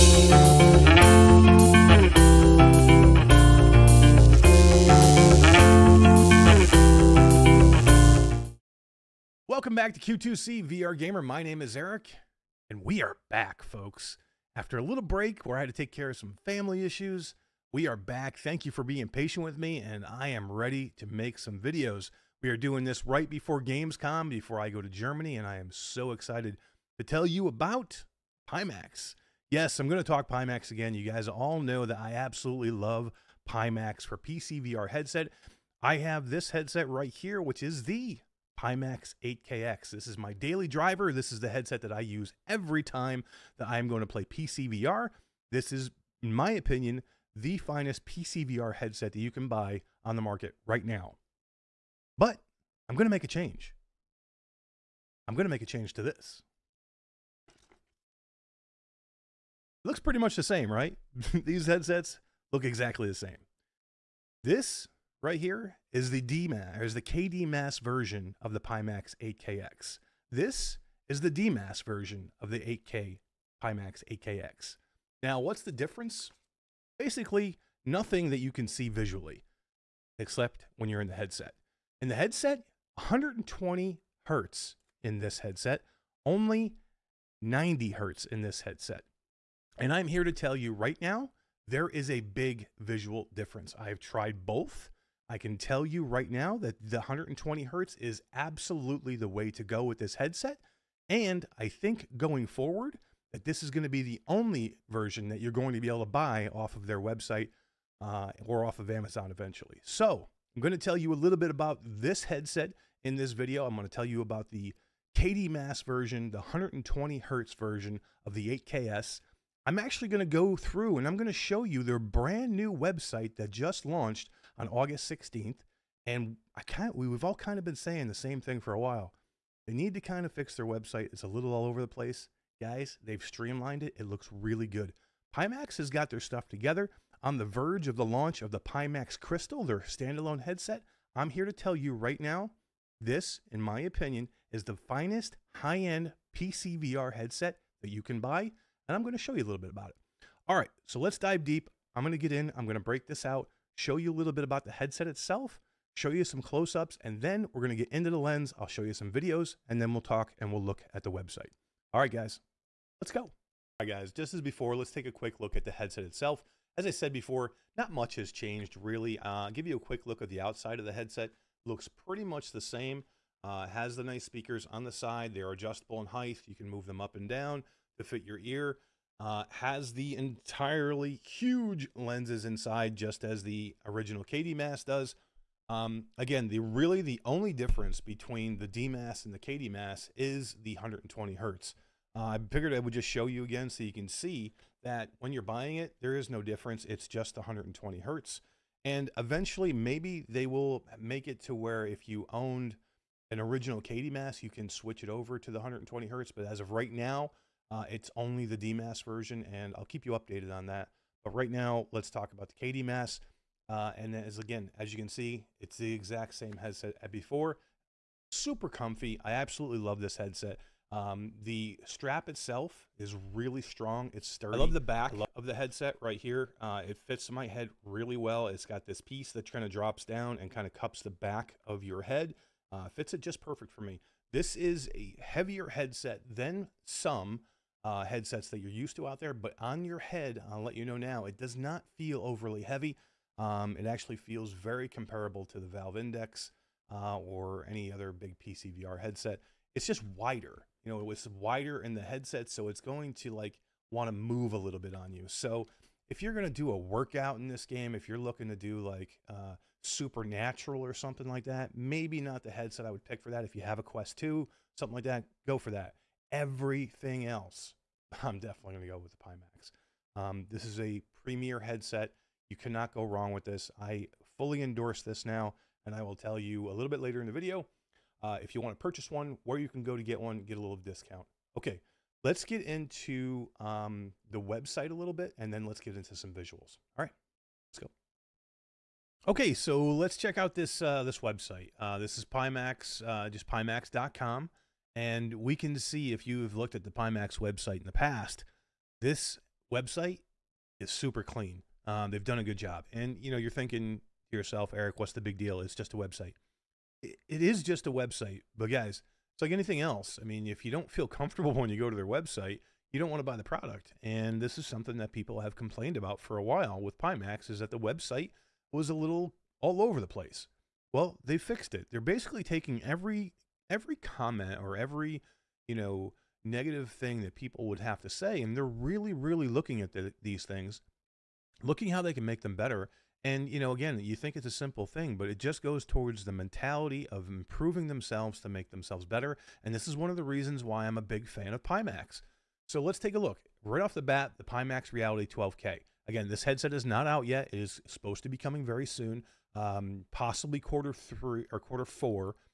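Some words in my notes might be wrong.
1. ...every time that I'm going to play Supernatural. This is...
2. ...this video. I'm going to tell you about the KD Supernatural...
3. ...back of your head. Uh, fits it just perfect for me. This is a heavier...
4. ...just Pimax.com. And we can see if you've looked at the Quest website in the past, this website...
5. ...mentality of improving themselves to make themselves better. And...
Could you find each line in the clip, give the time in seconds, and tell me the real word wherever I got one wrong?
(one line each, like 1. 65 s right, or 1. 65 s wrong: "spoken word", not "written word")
1. 42 s wrong: "PCVR", not "Supernatural"
2. 113 s wrong: "Mass", not "Supernatural"
3. 231 s right
4. 293 s wrong: "Pimax", not "Quest"
5. 336 s right.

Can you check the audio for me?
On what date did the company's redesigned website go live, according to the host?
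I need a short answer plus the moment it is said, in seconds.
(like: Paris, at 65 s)
August 16th, at 124 s.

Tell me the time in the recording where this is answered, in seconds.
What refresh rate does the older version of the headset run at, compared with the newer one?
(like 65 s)
87 s.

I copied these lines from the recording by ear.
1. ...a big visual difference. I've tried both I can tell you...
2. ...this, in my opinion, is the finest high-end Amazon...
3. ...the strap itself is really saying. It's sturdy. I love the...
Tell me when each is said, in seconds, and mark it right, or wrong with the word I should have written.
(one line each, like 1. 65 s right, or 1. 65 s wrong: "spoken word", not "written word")
1. 92 s right
2. 142 s wrong: "PCVR", not "Amazon"
3. 221 s wrong: "strong", not "saying".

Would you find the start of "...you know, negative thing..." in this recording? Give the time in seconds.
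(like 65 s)
325 s.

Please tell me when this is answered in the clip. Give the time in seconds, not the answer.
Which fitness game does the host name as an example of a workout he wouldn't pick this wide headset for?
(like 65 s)
259 s.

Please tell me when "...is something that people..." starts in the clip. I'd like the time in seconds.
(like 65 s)
314 s.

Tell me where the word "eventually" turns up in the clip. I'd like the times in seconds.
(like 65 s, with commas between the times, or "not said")
109 s, 199 s.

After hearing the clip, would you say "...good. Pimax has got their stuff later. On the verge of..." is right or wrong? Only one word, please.
wrong.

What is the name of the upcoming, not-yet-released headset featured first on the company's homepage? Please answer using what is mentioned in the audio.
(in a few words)
Pimax Reality 12K.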